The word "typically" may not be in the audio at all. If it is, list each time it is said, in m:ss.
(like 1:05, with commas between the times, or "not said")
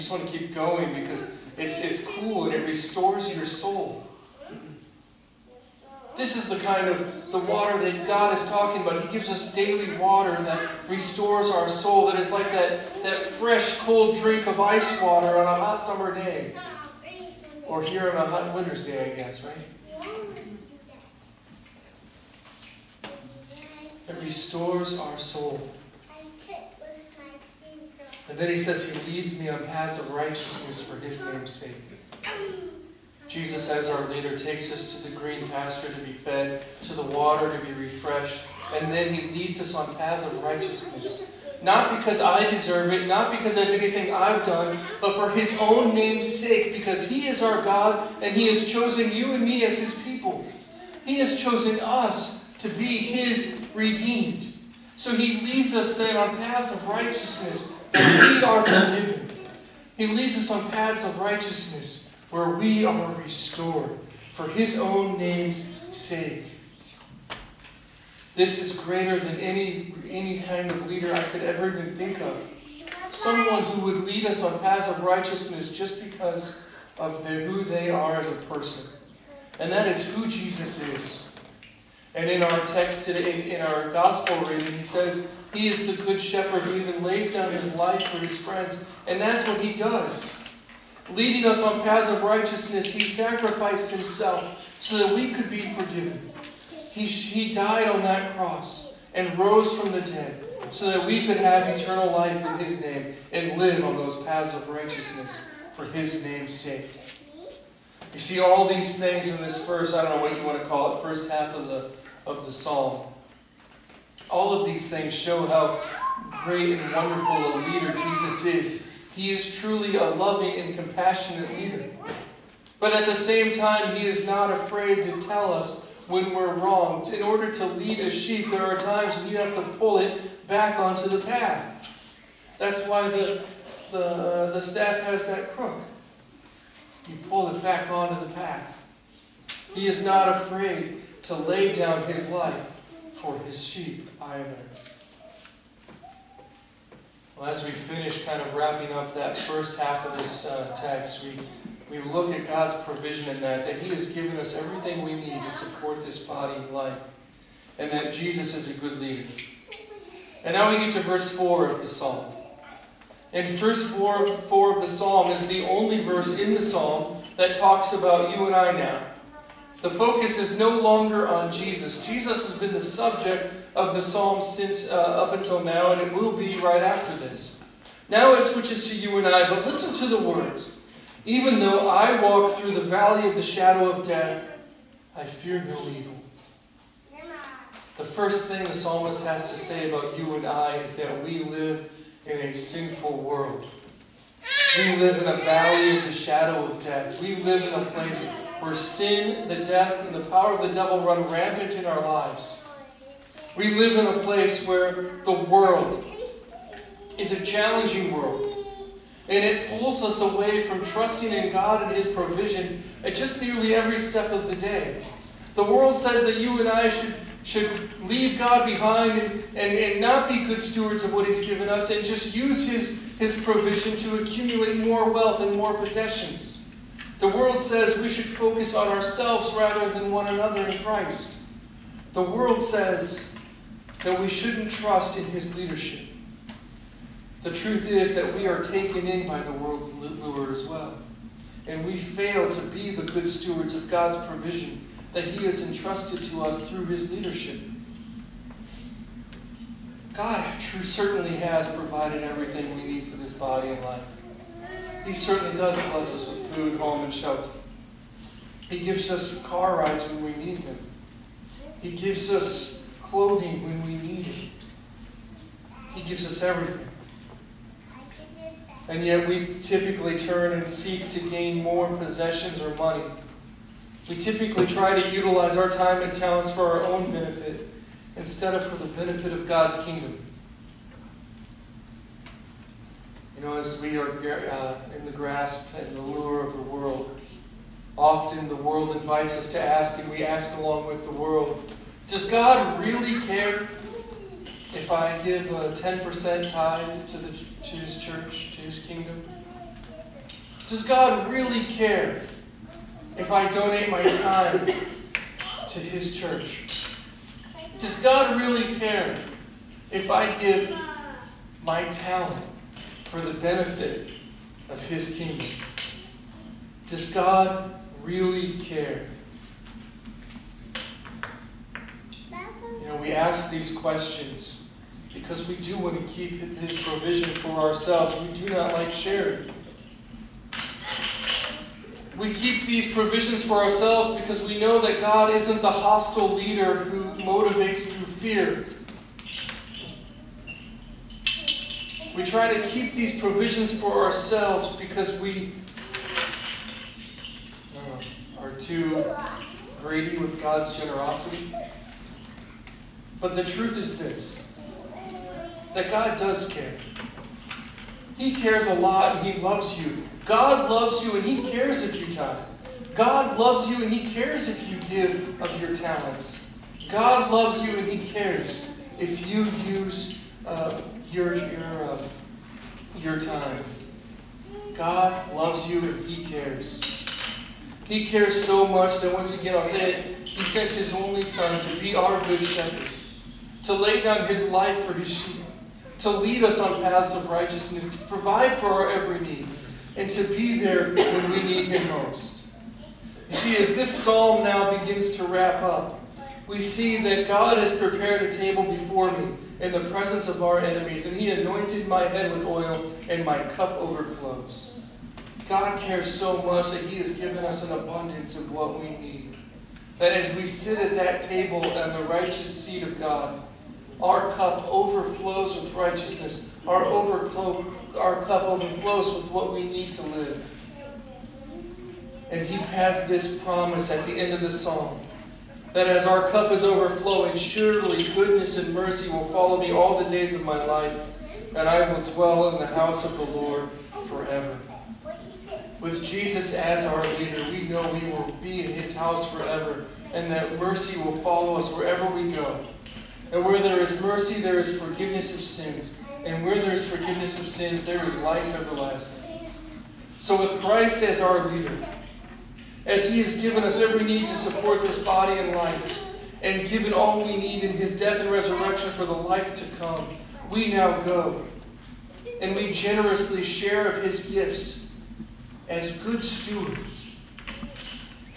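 4:29, 4:34.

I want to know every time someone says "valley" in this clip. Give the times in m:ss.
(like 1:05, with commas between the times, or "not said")
3:02, 3:15.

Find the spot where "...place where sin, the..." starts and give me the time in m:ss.
3:17.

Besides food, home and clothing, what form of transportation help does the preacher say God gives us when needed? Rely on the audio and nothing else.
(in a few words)
car rides.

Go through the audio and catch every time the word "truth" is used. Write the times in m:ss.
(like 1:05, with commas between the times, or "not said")
3:57, 5:53.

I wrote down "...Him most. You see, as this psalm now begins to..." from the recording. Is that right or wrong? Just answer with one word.
right.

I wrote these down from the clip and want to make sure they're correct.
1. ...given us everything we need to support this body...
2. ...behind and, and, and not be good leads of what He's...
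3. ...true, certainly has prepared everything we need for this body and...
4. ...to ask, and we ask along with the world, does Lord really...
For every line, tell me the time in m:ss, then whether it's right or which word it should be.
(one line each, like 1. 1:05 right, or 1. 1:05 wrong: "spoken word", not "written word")
1. 2:34 right
2. 3:38 wrong: "stewards", not "leads"
3. 4:10 wrong: "provided", not "prepared"
4. 4:49 wrong: "God", not "Lord".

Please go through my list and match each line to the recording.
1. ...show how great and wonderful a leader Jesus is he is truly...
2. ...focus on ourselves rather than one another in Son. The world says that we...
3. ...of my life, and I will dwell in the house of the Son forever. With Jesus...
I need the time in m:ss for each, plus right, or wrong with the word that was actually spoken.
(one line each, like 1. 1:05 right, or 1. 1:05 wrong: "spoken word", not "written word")
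1. 1:55 right
2. 3:48 wrong: "Christ", not "Son"
3. 7:10 wrong: "Lord", not "Son".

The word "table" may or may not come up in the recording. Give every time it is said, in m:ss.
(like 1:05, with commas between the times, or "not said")
6:38, 6:51.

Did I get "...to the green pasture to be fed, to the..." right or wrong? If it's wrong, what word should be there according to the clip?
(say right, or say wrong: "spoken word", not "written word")
right.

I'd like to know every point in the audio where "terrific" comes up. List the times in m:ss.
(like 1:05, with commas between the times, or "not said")
not said.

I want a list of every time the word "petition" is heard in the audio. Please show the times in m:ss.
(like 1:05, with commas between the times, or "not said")
not said.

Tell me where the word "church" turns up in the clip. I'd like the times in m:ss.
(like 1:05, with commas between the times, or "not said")
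4:58, 5:06.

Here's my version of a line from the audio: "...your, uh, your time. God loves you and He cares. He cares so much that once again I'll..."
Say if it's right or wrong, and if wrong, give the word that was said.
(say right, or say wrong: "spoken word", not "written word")
right.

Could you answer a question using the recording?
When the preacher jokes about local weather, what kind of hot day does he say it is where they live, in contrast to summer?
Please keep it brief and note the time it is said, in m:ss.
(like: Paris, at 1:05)
hot winter's day, at 0:18.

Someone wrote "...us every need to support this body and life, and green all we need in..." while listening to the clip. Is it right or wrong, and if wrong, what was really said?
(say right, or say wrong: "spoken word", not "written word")
wrong: "given", not "green".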